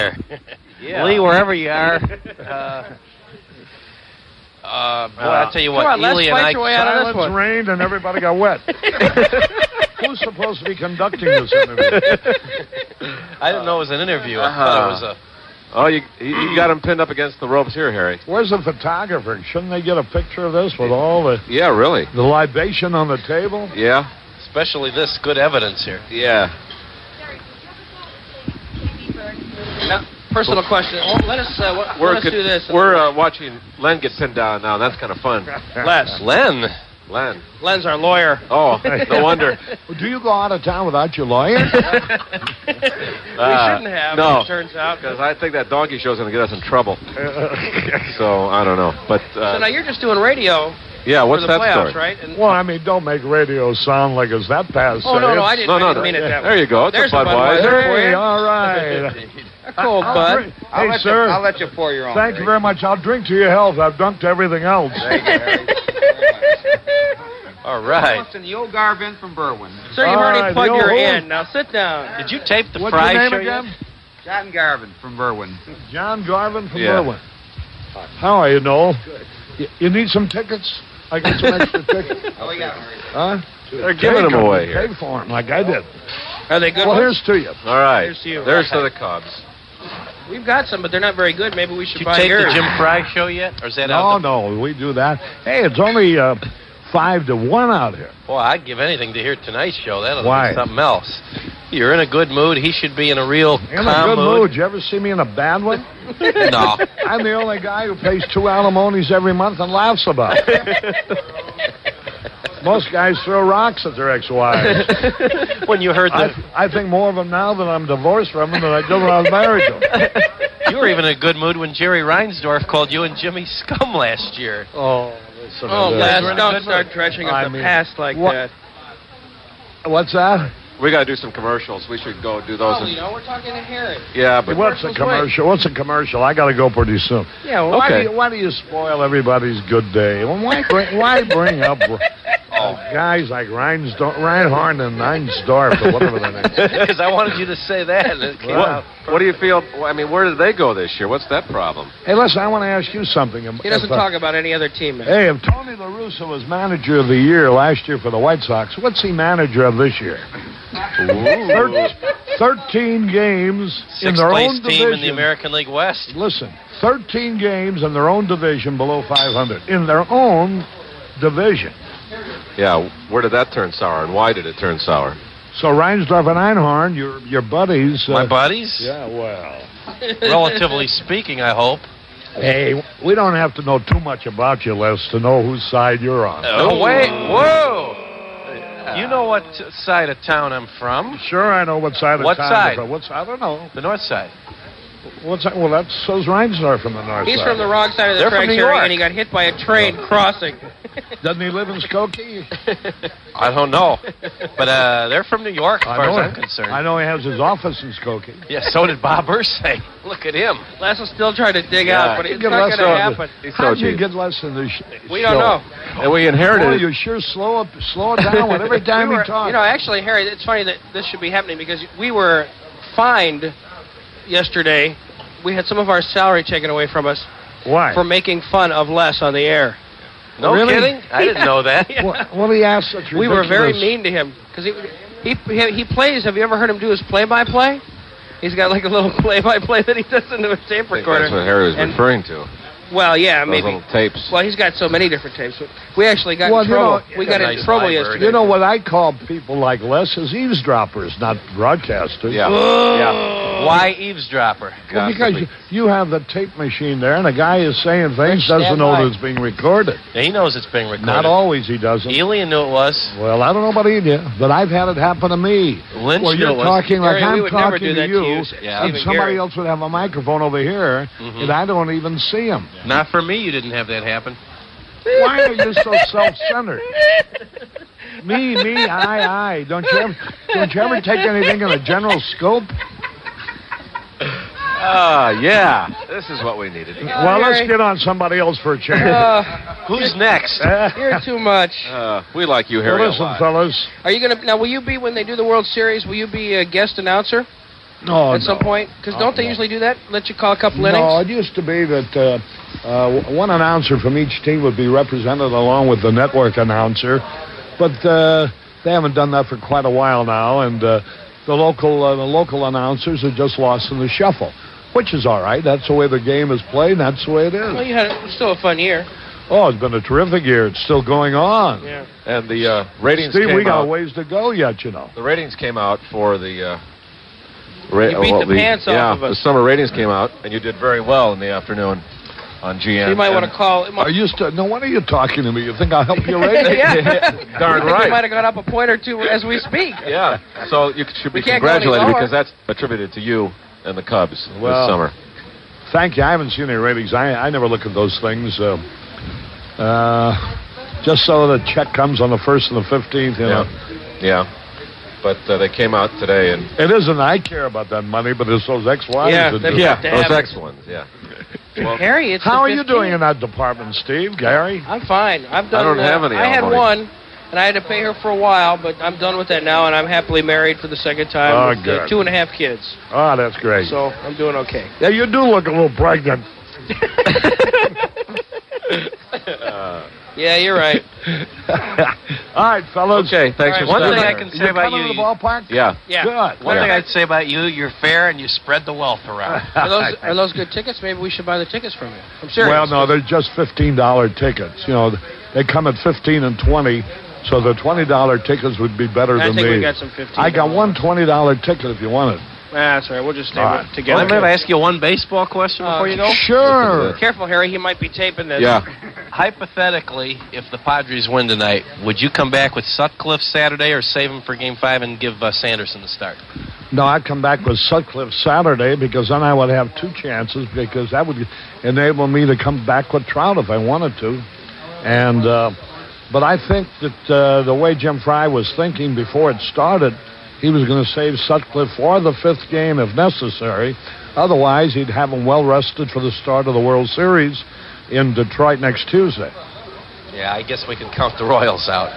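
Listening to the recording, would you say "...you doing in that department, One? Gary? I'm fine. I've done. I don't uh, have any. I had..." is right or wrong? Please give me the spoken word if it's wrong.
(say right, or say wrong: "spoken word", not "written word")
wrong: "Steve", not "One".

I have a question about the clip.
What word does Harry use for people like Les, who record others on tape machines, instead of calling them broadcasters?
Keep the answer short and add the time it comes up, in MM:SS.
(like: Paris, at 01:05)
Eavesdroppers, at 04:10.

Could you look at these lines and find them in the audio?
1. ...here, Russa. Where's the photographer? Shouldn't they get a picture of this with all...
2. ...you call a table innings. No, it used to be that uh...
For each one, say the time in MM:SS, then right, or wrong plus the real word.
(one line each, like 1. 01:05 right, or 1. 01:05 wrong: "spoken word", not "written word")
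1. 00:17 wrong: "Harry", not "Russa"
2. 05:00 wrong: "couple", not "table".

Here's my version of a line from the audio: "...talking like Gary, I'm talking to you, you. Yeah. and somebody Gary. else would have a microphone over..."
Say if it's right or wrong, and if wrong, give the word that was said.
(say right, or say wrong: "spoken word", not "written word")
right.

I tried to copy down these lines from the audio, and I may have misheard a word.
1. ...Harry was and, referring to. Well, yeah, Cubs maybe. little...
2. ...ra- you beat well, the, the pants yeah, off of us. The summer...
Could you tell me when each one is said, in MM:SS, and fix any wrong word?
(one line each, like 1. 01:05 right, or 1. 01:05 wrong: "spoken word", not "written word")
1. 04:01 wrong: "Those", not "Cubs"
2. 05:27 right.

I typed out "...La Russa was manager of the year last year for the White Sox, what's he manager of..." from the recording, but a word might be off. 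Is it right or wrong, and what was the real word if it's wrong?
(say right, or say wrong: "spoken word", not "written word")
right.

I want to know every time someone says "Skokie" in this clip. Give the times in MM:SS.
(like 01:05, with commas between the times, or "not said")
03:21, 03:27.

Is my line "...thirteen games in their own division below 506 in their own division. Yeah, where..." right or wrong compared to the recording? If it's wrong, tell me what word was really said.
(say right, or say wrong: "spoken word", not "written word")
wrong: "500", not "506".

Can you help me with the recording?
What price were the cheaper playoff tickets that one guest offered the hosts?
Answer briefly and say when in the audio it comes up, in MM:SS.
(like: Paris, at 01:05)
$15, at 06:33.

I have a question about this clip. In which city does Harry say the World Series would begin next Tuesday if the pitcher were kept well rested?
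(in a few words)
Detroit.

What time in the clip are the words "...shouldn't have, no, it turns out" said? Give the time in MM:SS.
00:42.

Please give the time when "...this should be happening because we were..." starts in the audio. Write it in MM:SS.
03:40.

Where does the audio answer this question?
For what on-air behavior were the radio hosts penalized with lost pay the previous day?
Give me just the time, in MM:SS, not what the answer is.
03:48.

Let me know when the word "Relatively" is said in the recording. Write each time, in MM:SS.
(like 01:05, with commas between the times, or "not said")
03:00.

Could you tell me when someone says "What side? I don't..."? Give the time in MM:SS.
03:12.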